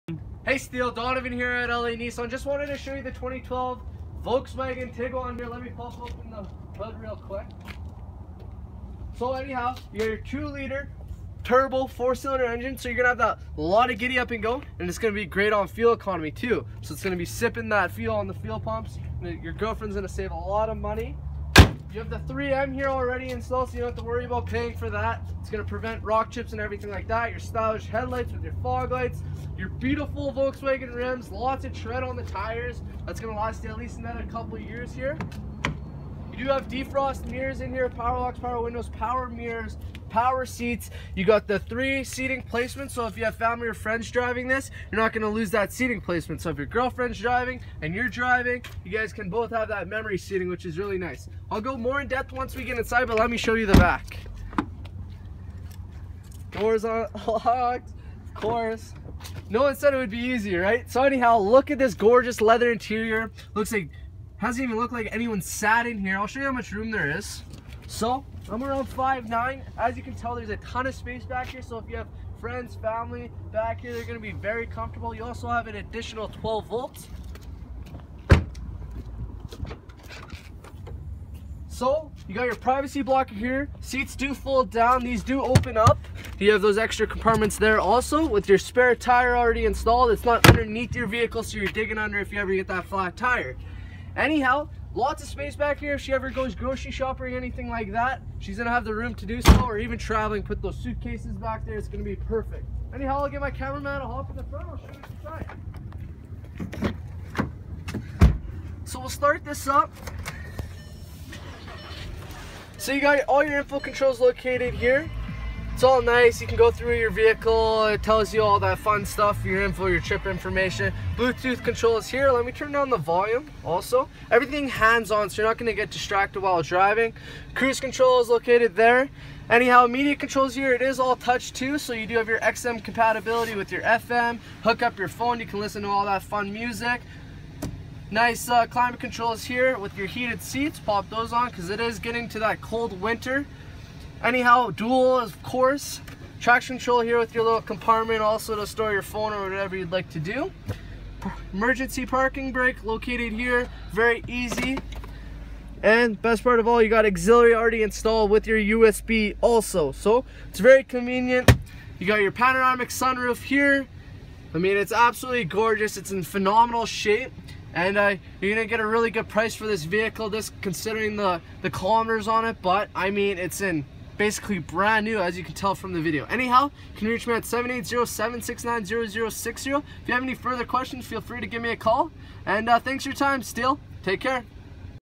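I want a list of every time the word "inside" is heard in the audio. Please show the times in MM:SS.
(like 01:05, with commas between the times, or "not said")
00:52, 01:46.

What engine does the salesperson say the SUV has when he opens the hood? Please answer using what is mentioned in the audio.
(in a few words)
2 liter turbo 4 cylinder.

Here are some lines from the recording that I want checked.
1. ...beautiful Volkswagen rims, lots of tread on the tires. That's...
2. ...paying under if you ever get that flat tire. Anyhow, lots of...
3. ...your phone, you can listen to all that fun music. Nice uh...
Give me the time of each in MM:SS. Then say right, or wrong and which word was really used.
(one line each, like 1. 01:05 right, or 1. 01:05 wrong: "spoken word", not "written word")
1. 00:29 right
2. 01:31 wrong: "digging", not "paying"
3. 02:14 right.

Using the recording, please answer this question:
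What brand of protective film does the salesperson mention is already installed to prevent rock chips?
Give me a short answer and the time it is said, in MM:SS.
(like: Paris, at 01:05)
3M, at 00:22.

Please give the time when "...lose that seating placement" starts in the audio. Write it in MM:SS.
00:45.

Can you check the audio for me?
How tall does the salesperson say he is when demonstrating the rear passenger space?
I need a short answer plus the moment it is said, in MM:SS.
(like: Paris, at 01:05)
5'9", at 01:08.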